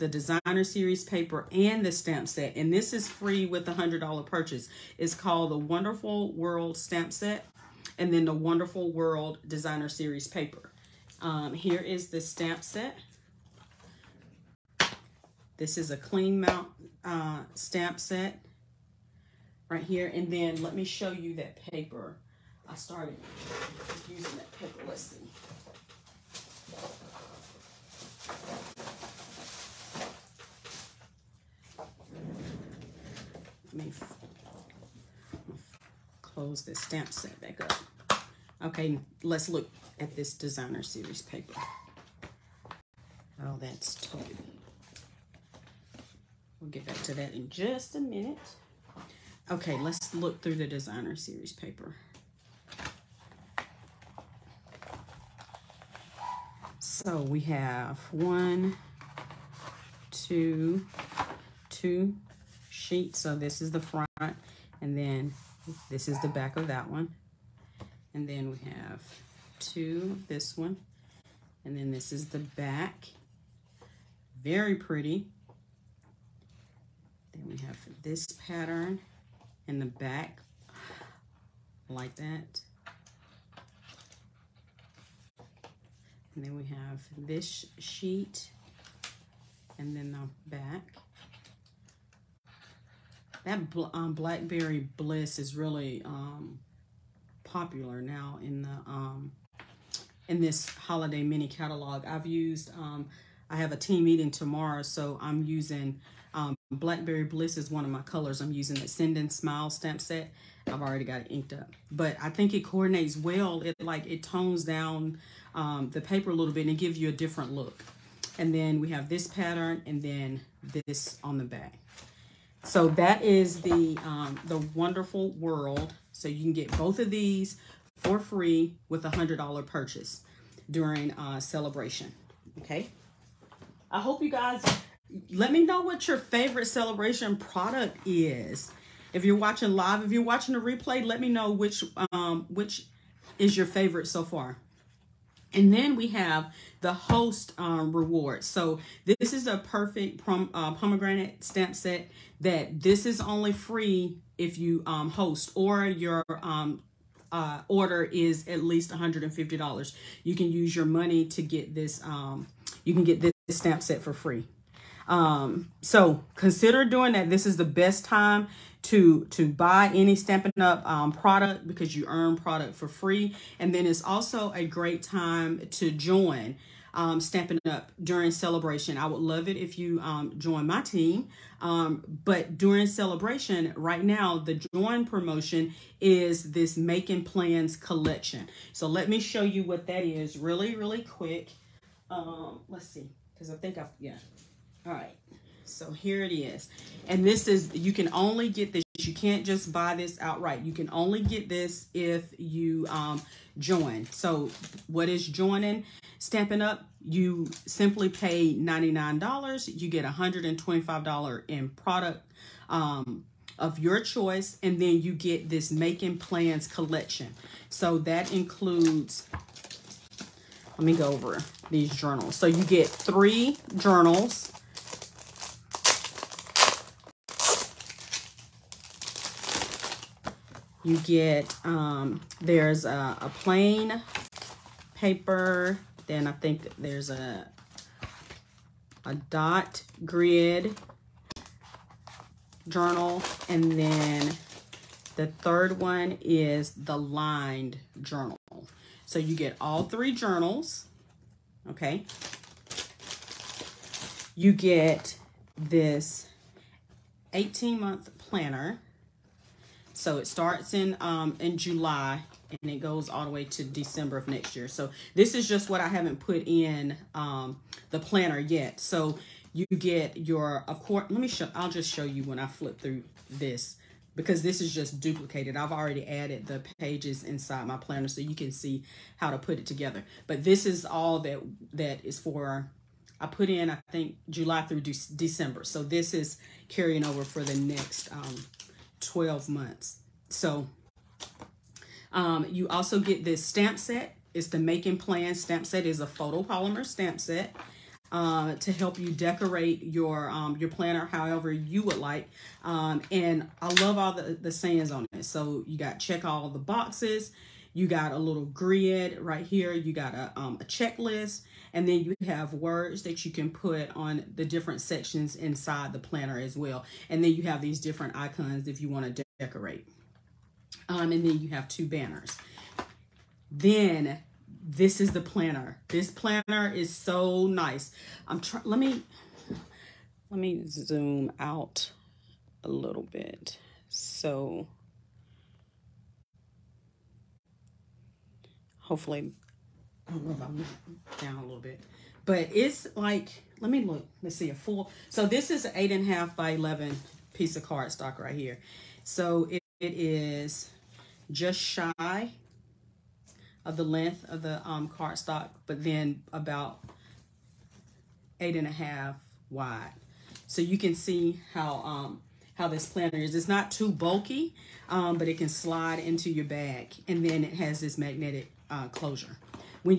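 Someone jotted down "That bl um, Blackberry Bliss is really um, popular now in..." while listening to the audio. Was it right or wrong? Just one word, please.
right.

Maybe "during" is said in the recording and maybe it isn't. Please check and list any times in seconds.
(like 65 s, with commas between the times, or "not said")
130 s, 178 s, 182 s.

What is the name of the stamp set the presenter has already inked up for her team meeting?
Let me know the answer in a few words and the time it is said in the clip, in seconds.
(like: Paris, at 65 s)
Send and Smile, at 108 s.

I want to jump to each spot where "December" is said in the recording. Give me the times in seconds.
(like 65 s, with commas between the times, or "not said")
263 s, 284 s.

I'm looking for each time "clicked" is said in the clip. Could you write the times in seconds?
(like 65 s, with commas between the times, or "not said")
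not said.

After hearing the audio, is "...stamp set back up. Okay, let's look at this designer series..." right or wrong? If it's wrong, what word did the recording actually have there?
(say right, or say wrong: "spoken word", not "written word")
right.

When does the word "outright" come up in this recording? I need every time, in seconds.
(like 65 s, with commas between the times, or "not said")
200 s.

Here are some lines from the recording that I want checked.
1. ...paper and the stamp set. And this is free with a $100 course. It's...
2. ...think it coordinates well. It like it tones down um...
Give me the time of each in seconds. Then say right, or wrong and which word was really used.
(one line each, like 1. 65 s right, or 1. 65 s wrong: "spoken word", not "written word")
1. 1 s wrong: "purchase", not "course"
2. 112 s right.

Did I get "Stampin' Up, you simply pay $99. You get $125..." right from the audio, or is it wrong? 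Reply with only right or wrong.
right.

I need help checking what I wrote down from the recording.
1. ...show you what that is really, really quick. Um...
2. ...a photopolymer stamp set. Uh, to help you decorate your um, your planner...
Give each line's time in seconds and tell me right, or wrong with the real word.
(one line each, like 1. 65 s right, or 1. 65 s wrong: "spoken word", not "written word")
1. 189 s right
2. 295 s right.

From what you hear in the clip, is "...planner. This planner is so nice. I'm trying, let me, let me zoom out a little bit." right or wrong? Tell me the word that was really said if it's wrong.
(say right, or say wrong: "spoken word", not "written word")
right.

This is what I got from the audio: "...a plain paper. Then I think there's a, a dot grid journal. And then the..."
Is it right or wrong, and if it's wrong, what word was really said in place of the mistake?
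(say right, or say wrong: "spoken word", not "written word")
right.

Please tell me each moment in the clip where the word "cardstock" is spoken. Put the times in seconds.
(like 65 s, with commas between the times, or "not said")
347 s, 354 s.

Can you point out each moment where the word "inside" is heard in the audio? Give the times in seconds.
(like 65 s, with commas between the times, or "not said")
277 s, 315 s.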